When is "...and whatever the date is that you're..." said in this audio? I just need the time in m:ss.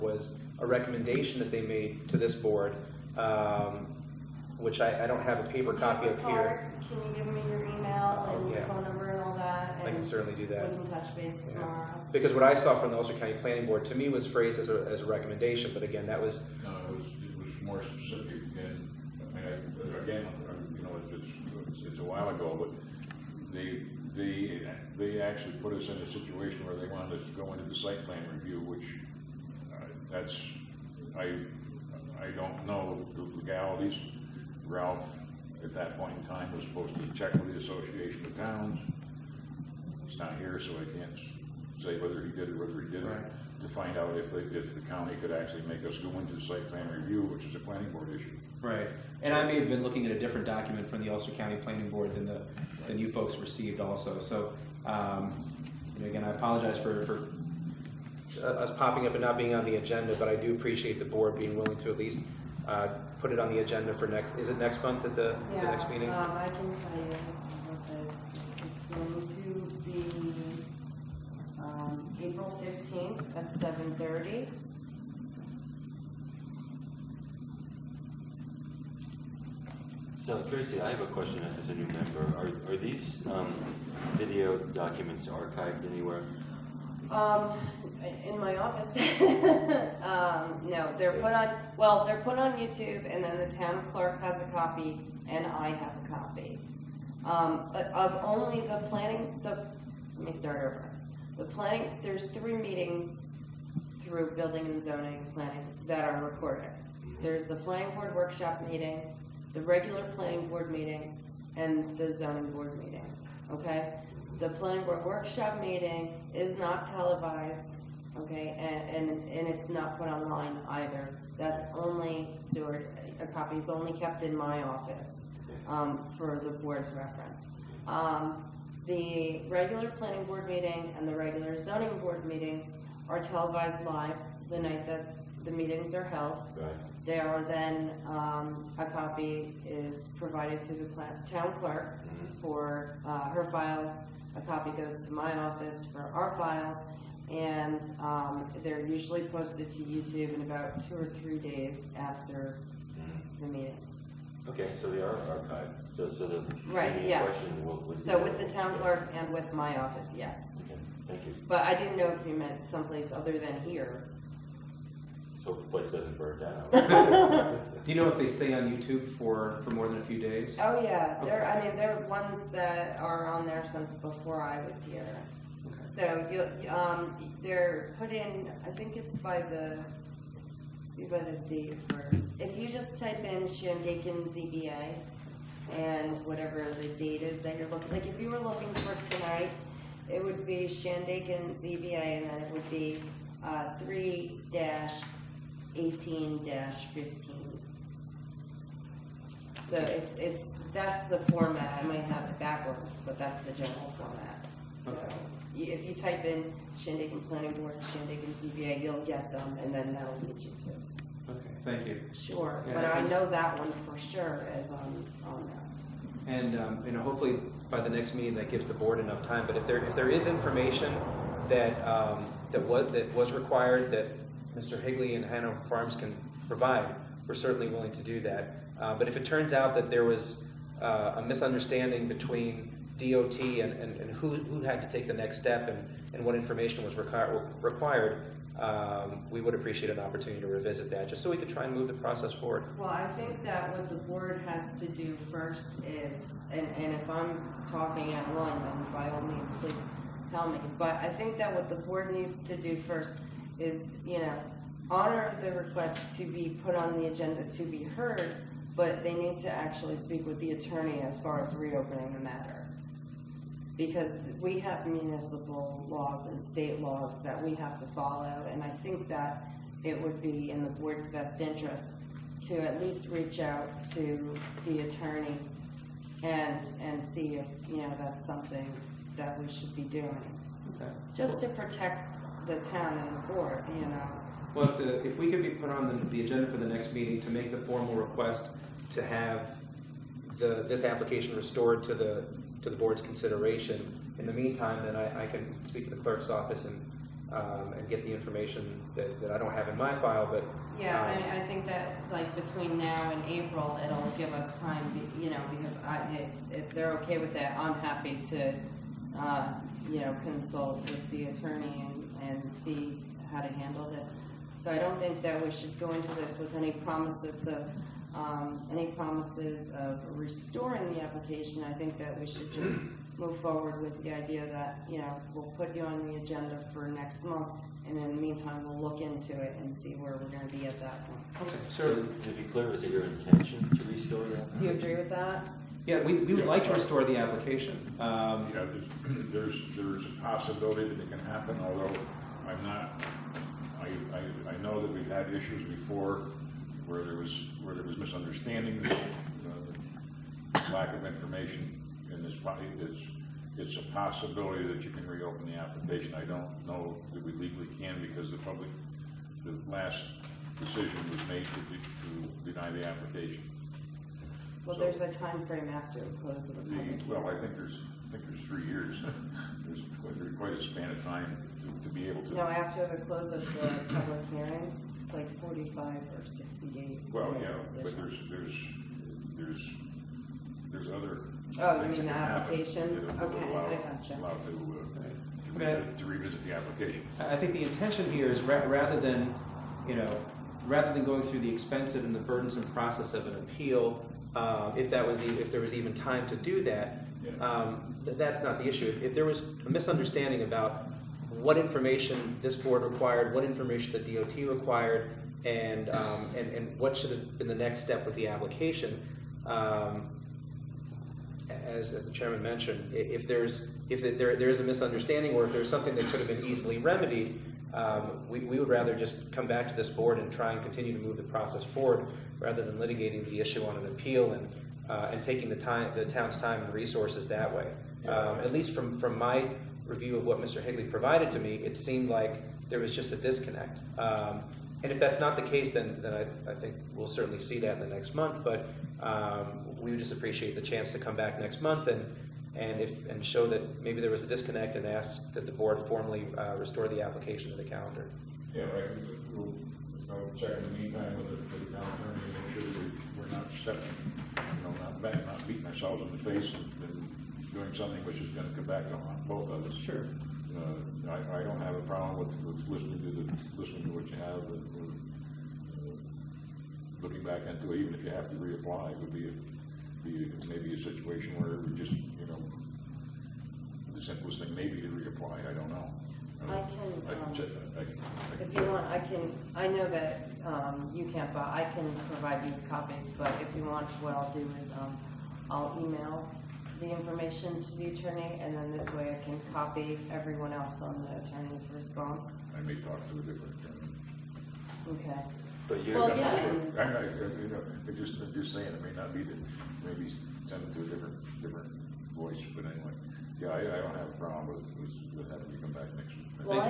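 3:05.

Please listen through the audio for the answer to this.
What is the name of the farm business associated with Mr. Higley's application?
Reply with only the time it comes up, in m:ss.
3:45.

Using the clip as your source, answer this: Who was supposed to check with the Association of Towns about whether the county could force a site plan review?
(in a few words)
Ralph.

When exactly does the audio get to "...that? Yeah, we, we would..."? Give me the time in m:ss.
5:35.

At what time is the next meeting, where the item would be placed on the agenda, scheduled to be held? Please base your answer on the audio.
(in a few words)
7:30.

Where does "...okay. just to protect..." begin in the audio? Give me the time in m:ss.
4:40.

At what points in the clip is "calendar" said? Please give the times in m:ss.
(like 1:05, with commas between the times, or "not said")
7:27, 7:31.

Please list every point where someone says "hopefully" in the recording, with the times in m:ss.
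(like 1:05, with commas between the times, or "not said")
3:37.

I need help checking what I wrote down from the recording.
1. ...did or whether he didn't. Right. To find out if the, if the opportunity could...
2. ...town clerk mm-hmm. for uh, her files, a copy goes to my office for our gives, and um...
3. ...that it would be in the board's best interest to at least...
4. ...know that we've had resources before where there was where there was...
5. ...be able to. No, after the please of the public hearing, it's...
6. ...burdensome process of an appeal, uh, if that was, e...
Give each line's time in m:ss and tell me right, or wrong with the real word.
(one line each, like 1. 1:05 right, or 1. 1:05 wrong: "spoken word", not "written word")
1. 0:42 wrong: "county", not "opportunity"
2. 2:21 wrong: "files", not "gives"
3. 4:29 right
4. 5:44 wrong: "issues", not "resources"
5. 6:11 wrong: "close", not "please"
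6. 6:32 right.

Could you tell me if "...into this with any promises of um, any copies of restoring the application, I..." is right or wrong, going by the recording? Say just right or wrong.
wrong.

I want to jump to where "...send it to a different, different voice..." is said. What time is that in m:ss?
8:20.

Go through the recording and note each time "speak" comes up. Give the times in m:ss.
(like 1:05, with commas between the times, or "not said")
4:19, 4:55.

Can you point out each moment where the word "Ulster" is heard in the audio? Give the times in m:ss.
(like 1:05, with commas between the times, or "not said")
0:12, 0:51.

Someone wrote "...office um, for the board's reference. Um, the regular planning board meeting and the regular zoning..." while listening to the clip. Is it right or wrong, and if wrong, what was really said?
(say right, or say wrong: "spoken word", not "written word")
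right.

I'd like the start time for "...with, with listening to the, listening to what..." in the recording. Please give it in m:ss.
7:42.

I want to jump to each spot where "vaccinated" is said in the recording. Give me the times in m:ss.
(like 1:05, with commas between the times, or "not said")
not said.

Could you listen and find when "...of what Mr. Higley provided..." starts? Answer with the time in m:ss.
7:10.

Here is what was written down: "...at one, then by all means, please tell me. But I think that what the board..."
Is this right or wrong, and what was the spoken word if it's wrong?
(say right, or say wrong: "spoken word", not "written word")
right.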